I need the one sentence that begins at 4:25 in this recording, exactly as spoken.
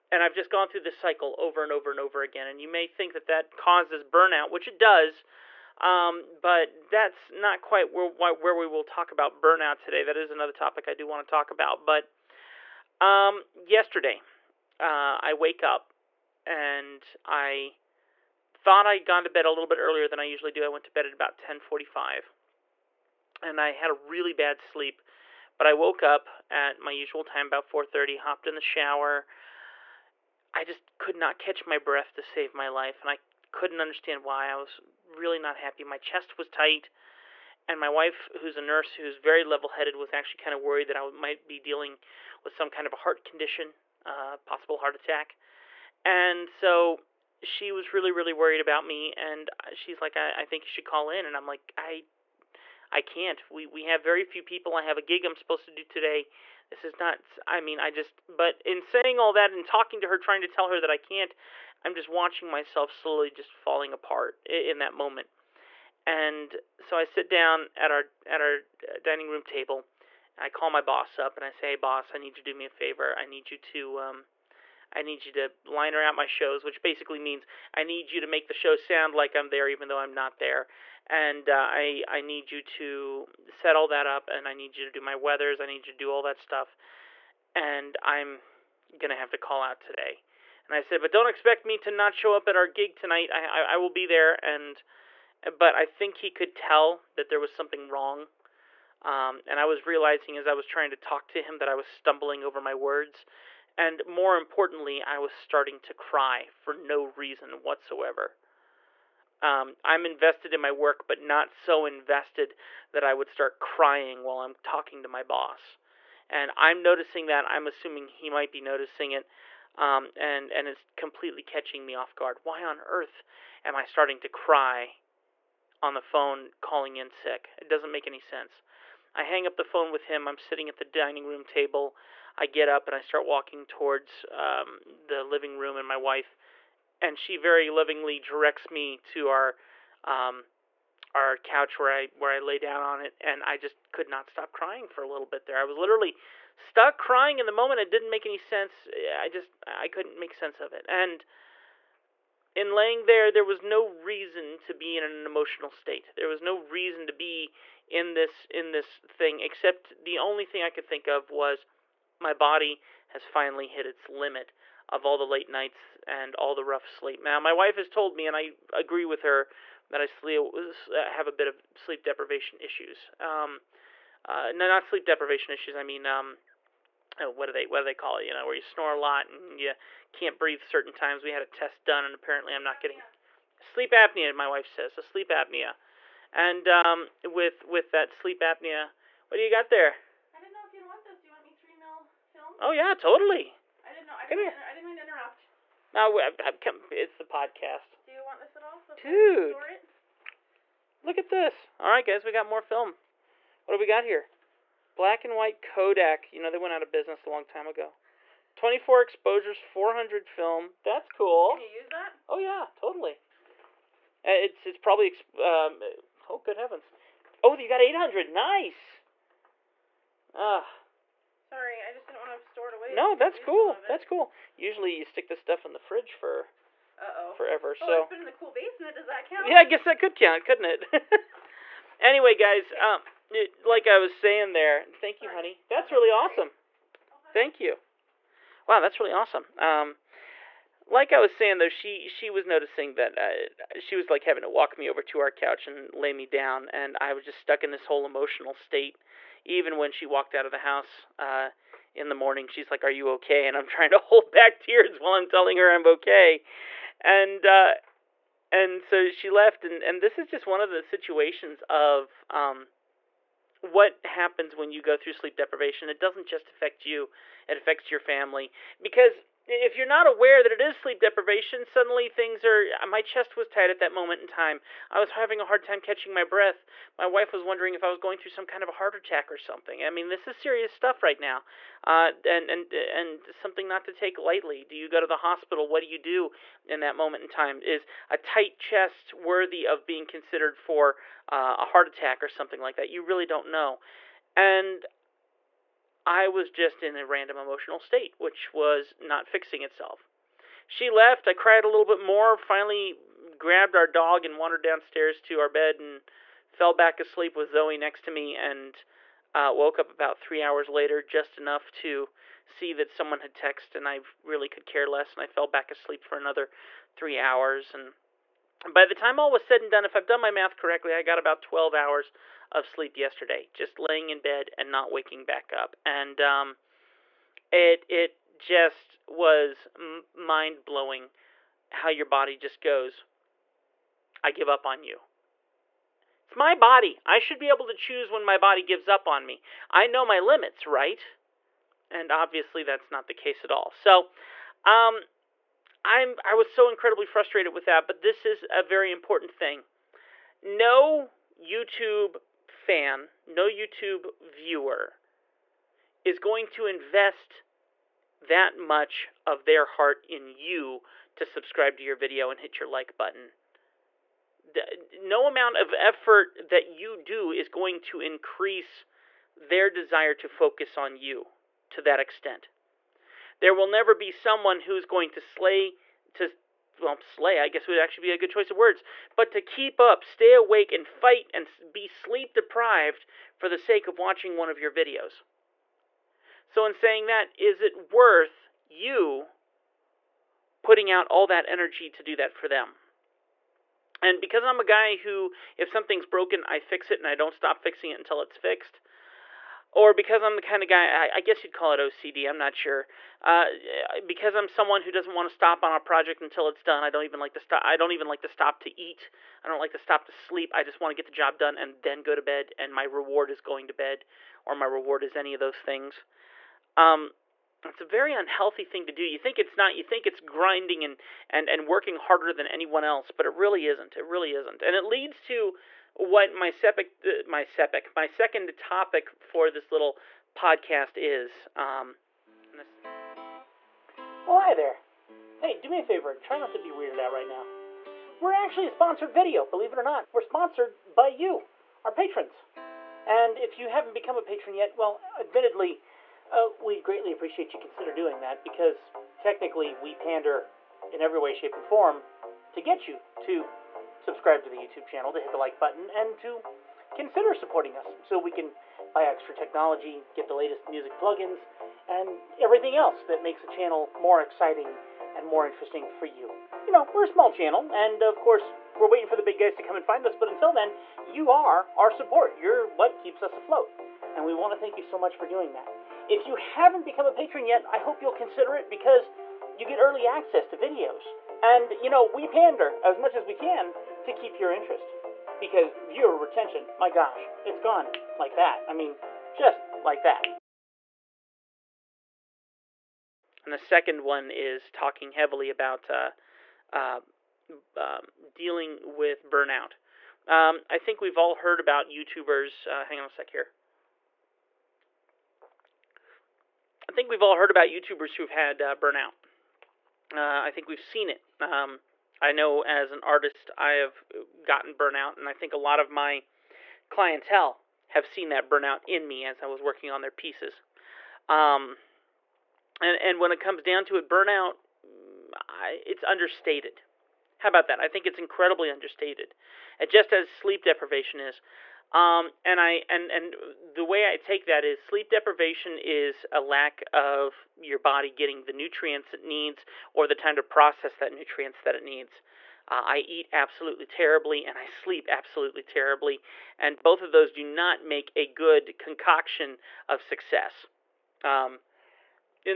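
It doesn't just affect you, it affects your family.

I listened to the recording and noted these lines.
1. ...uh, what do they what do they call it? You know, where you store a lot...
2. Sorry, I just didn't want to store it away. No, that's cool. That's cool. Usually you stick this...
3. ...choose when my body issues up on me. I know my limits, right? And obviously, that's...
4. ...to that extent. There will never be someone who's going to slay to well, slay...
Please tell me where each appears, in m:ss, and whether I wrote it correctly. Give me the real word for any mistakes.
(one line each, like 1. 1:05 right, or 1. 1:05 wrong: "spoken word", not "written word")
1. 2:57 wrong: "snore", not "store"
2. 3:41 right
3. 5:37 wrong: "gives", not "issues"
4. 6:11 right.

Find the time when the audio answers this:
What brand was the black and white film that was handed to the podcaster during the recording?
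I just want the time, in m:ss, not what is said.
3:25.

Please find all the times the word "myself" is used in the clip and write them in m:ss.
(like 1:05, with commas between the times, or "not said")
1:02.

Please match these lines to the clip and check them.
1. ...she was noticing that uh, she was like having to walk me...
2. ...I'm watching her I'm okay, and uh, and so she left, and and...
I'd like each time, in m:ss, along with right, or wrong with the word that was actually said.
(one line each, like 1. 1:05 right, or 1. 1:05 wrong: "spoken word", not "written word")
1. 4:02 right
2. 4:15 wrong: "telling", not "watching".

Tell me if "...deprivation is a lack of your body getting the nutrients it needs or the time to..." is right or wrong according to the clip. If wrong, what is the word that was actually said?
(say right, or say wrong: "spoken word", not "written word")
right.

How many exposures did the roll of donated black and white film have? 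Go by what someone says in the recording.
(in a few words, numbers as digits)
24.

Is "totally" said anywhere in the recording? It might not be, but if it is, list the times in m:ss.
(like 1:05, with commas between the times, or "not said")
3:12, 3:32.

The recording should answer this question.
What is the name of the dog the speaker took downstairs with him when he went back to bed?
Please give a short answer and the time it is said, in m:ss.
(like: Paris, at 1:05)
Zoe, at 5:07.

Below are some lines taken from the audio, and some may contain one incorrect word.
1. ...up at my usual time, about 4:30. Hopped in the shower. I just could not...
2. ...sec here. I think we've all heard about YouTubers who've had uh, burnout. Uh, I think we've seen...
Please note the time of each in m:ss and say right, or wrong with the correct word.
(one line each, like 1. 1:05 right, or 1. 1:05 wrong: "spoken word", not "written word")
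1. 0:26 right
2. 8:23 right.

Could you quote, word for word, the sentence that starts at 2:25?
I was literally stuck crying in the moment.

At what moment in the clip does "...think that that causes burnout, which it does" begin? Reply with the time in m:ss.
0:02.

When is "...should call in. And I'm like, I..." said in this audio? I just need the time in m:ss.
0:50.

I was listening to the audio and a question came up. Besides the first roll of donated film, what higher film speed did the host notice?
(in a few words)
800.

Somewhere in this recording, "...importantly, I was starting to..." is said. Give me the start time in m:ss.
1:44.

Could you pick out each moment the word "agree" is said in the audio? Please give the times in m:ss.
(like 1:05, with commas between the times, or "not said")
2:48.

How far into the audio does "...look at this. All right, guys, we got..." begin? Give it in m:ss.
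3:21.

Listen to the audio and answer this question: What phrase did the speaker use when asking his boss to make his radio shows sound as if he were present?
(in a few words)
liner out.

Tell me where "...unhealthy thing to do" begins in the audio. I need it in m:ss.
6:58.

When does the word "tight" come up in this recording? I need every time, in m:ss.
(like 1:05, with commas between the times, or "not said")
0:36, 4:33, 4:48.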